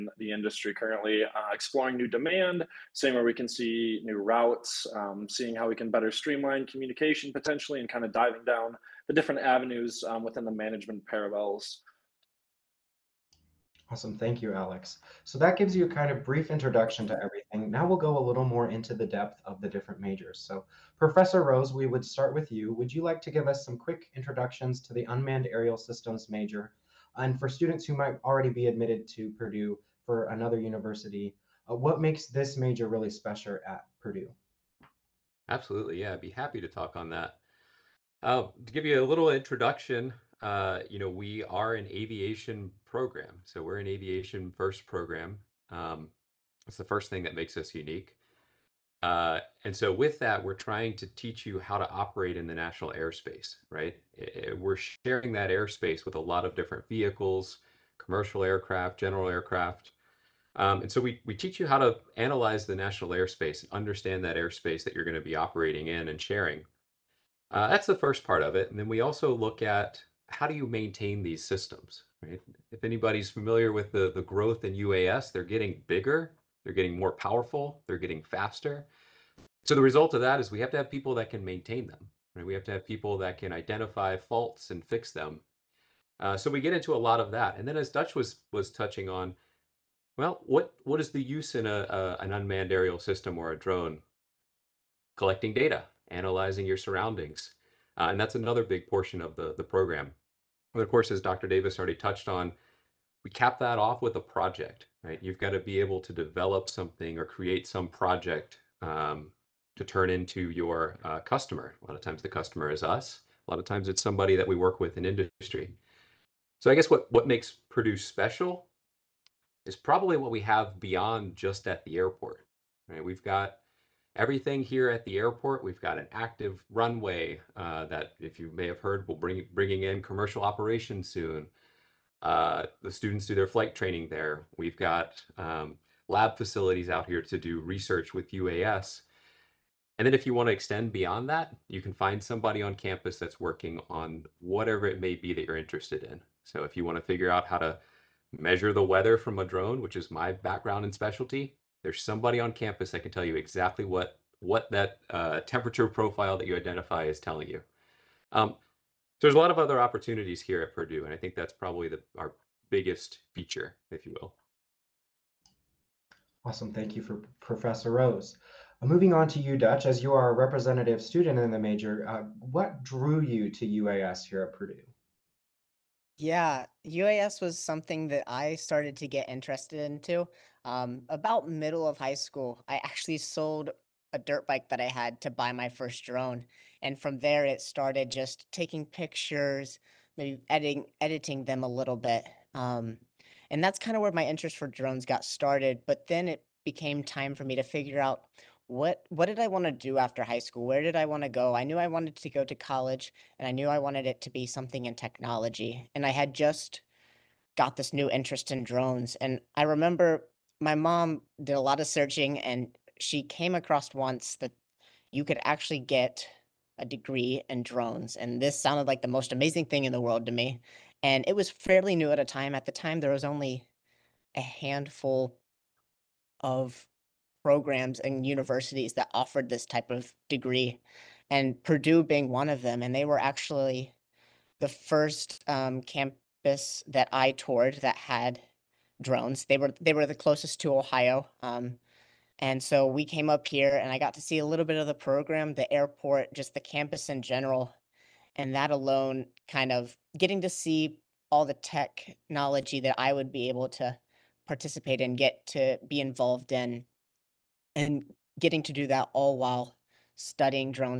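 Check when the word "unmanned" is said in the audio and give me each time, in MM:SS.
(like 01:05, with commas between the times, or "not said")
00:25, 01:32.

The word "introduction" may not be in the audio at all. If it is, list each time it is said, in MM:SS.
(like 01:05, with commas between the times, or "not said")
00:16, 00:24, 00:39.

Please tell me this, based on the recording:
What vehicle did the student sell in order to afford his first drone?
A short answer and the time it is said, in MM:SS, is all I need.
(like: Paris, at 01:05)
dirt bike, at 03:04.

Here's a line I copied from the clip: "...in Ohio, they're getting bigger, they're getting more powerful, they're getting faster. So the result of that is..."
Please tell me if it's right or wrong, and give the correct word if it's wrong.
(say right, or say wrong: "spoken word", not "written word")
wrong: "UAS", not "Ohio".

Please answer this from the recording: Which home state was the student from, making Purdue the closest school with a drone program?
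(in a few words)
Ohio.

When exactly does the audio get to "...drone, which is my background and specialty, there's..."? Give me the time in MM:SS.
02:29.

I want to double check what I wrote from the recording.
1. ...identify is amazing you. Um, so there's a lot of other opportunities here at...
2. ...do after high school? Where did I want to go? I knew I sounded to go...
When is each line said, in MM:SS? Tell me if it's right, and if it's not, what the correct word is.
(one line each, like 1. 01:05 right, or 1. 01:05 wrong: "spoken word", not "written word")
1. 02:36 wrong: "telling", not "amazing"
2. 03:19 wrong: "wanted", not "sounded".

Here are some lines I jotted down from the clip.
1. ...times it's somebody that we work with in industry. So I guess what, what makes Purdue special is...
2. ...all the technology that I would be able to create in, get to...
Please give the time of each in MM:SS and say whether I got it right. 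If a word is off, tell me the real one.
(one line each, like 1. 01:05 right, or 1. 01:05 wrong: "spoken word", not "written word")
1. 01:53 right
2. 04:11 wrong: "participate", not "create".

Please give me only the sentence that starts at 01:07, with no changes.
Uh, that's the first part of it.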